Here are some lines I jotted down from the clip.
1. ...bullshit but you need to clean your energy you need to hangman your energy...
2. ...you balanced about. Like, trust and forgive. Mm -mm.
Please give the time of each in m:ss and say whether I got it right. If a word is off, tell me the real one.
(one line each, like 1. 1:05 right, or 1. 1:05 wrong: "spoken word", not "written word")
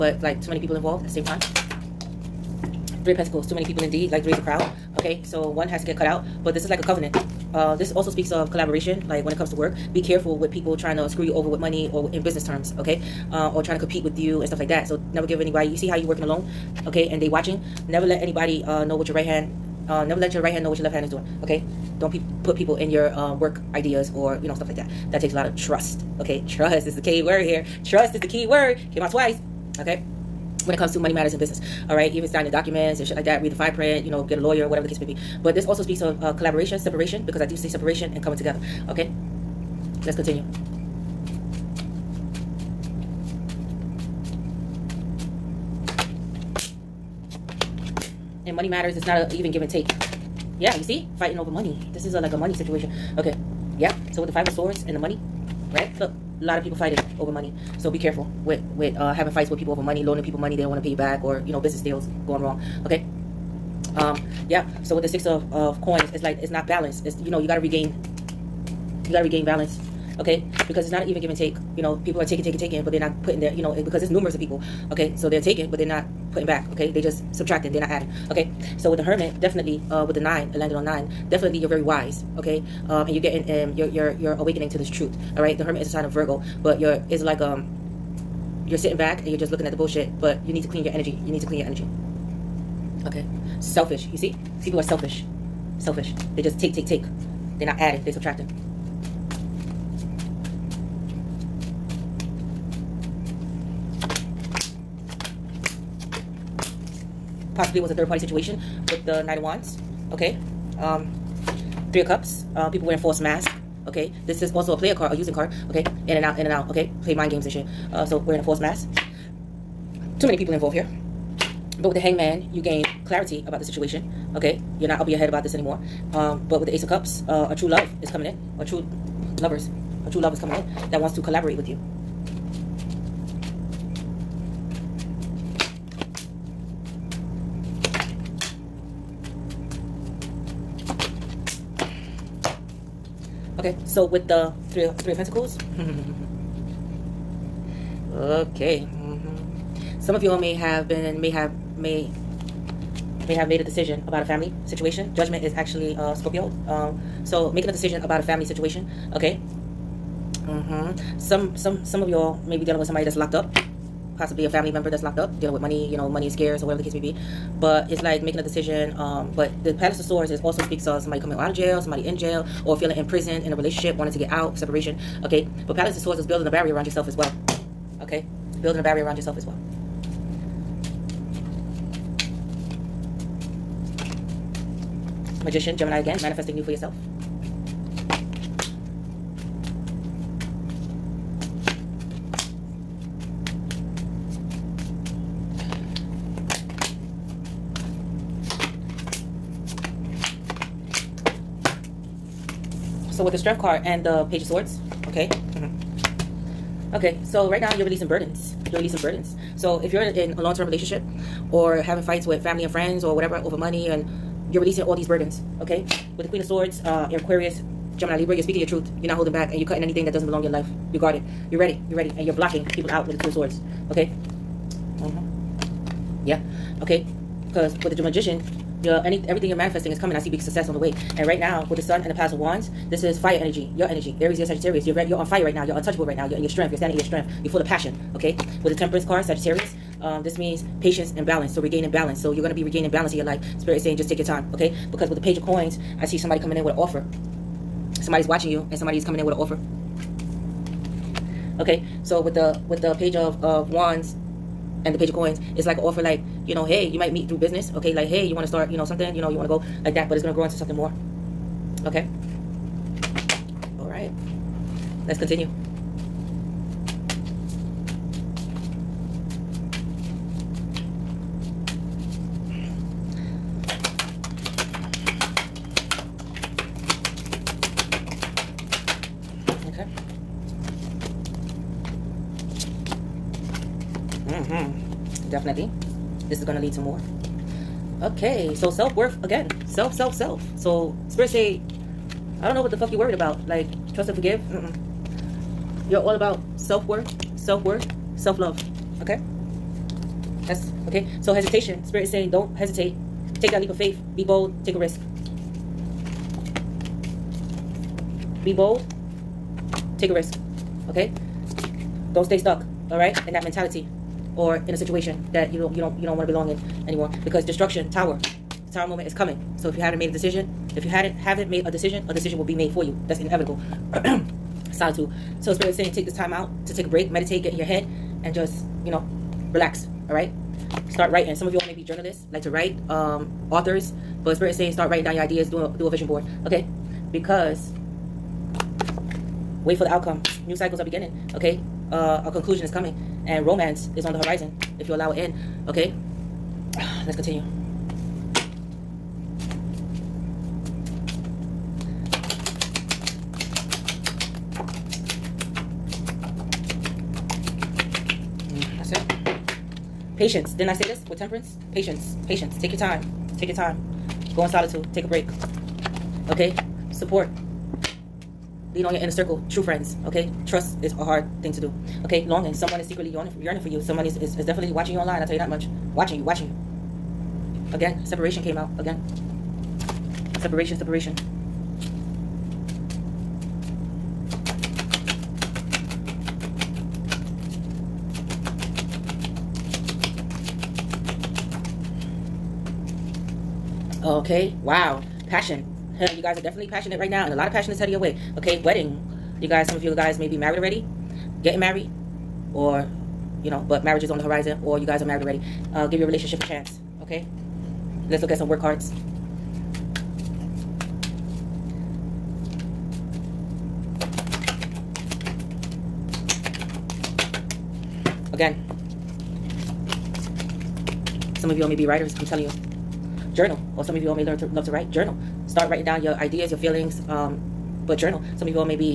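1. 1:29 wrong: "clean", not "hangman"
2. 4:52 wrong: "worried", not "balanced".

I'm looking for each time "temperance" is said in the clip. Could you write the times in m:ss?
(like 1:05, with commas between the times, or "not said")
3:58, 6:01.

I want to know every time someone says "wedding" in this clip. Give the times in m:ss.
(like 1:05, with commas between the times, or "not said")
6:38.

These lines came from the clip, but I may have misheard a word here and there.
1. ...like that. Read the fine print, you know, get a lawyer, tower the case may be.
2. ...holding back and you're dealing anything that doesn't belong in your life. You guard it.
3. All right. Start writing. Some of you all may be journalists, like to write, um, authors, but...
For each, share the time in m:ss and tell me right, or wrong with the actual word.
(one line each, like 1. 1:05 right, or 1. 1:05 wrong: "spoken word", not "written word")
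1. 0:33 wrong: "whatever", not "tower"
2. 3:39 wrong: "cutting", not "dealing"
3. 5:30 right.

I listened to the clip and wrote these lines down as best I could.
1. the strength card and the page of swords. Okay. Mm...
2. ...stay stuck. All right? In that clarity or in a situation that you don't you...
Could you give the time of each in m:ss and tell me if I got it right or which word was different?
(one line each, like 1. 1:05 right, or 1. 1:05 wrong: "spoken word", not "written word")
1. 3:23 right
2. 5:12 wrong: "mentality", not "clarity".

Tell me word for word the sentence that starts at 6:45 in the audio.
Uh, give your relationship a chance.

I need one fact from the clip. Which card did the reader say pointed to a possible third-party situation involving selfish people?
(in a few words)
Knight of Wands.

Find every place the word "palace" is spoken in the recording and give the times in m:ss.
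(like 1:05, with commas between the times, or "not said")
2:49, 2:55, 3:52.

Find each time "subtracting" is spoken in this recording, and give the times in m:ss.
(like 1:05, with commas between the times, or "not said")
1:17, 1:38.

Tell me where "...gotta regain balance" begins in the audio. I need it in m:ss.
1:09.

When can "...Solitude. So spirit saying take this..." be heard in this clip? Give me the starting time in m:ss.
5:24.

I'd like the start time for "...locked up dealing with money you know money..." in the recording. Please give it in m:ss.
2:45.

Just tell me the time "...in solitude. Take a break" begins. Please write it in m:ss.
6:04.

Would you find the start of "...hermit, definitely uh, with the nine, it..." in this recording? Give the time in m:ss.
1:19.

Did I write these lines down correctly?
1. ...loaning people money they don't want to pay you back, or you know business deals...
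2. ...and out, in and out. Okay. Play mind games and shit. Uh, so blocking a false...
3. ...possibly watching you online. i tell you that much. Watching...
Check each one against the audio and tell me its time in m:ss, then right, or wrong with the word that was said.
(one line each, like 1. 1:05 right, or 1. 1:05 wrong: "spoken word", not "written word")
1. 1:00 right
2. 1:56 wrong: "wearing", not "blocking"
3. 6:14 wrong: "definitely", not "possibly".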